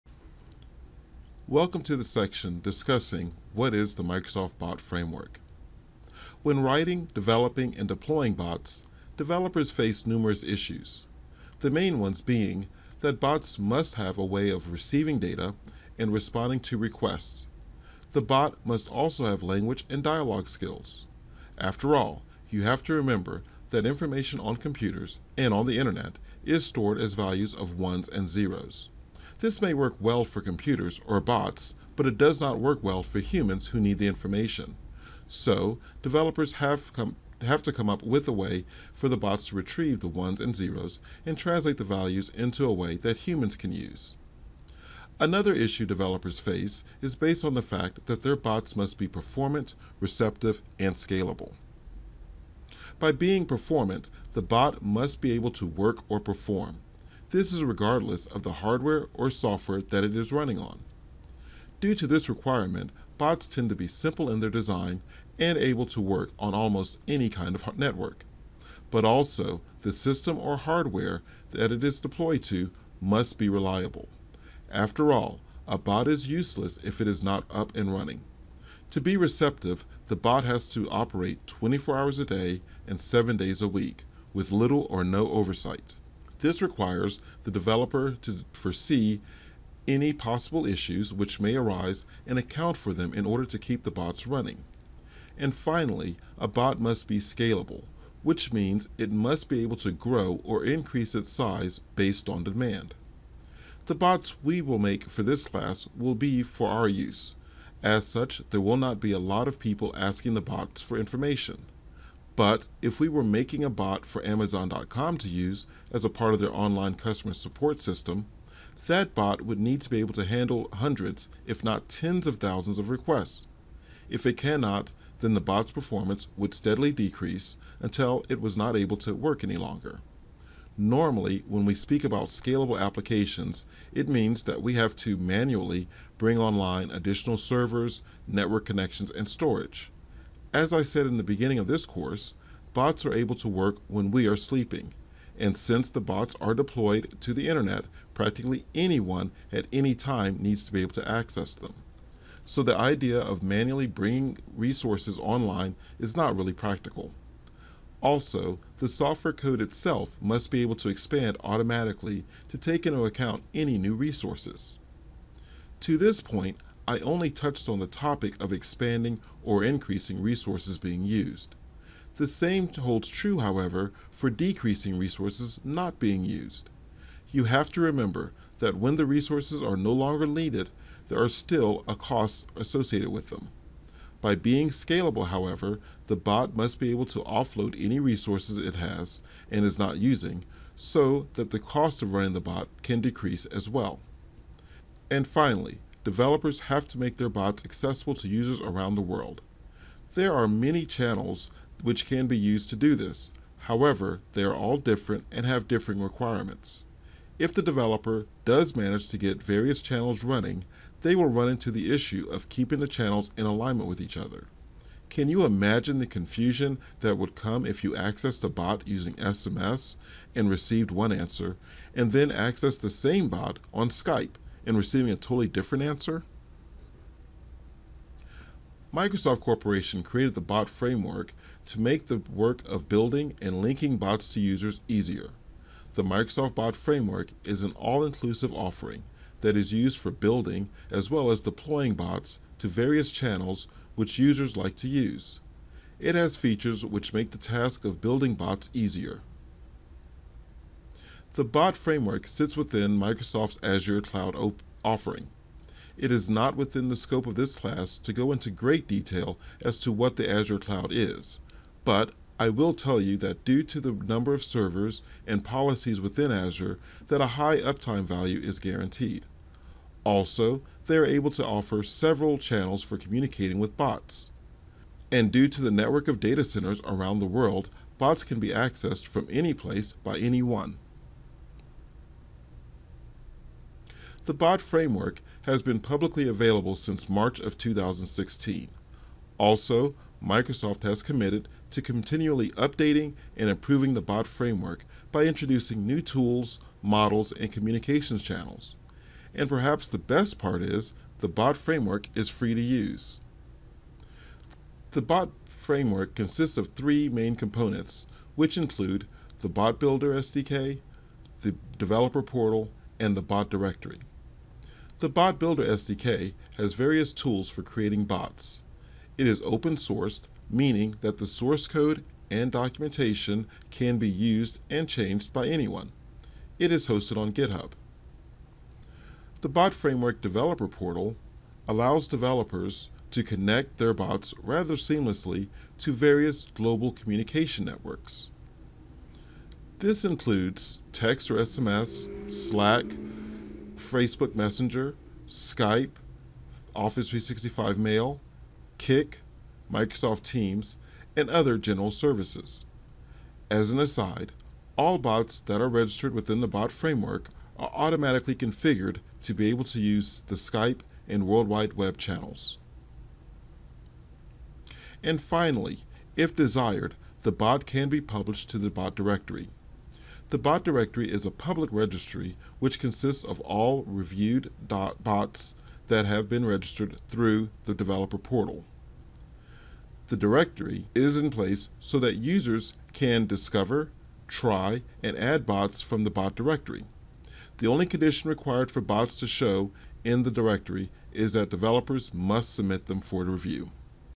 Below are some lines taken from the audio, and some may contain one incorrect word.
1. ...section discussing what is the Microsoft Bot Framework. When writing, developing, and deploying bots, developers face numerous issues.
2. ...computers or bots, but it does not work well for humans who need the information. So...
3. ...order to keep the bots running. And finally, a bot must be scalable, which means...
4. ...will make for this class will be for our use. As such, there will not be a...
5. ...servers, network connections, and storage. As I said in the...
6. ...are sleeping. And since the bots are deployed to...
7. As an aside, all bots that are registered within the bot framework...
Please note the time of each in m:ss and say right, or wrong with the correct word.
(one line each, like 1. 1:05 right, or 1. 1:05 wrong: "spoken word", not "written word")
1. 0:02 right
2. 0:30 right
3. 1:33 right
4. 1:44 right
5. 2:17 right
6. 2:24 right
7. 5:53 right.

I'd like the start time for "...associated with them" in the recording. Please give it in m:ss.
3:02.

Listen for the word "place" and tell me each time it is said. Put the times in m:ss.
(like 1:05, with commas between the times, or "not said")
4:39, 6:21.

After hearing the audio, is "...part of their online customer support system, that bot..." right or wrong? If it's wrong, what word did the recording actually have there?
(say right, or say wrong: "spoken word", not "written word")
right.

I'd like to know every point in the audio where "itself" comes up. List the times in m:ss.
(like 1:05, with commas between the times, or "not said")
2:39.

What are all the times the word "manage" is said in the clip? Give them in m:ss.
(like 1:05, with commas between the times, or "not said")
3:28.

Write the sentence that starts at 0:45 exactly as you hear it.
Another issue developers face is based on the fact that their bots must be performant, receptive, and scalable.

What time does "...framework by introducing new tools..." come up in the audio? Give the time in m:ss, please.
4:54.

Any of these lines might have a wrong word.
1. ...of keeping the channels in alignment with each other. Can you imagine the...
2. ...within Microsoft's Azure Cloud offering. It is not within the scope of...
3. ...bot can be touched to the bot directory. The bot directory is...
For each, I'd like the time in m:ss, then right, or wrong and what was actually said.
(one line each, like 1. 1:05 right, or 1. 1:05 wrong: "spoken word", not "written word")
1. 3:32 right
2. 4:12 right
3. 6:07 wrong: "published", not "touched".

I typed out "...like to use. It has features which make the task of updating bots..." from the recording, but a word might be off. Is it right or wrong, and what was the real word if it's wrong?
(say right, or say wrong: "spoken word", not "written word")
wrong: "building", not "updating".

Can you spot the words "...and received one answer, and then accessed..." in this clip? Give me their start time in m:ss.
3:40.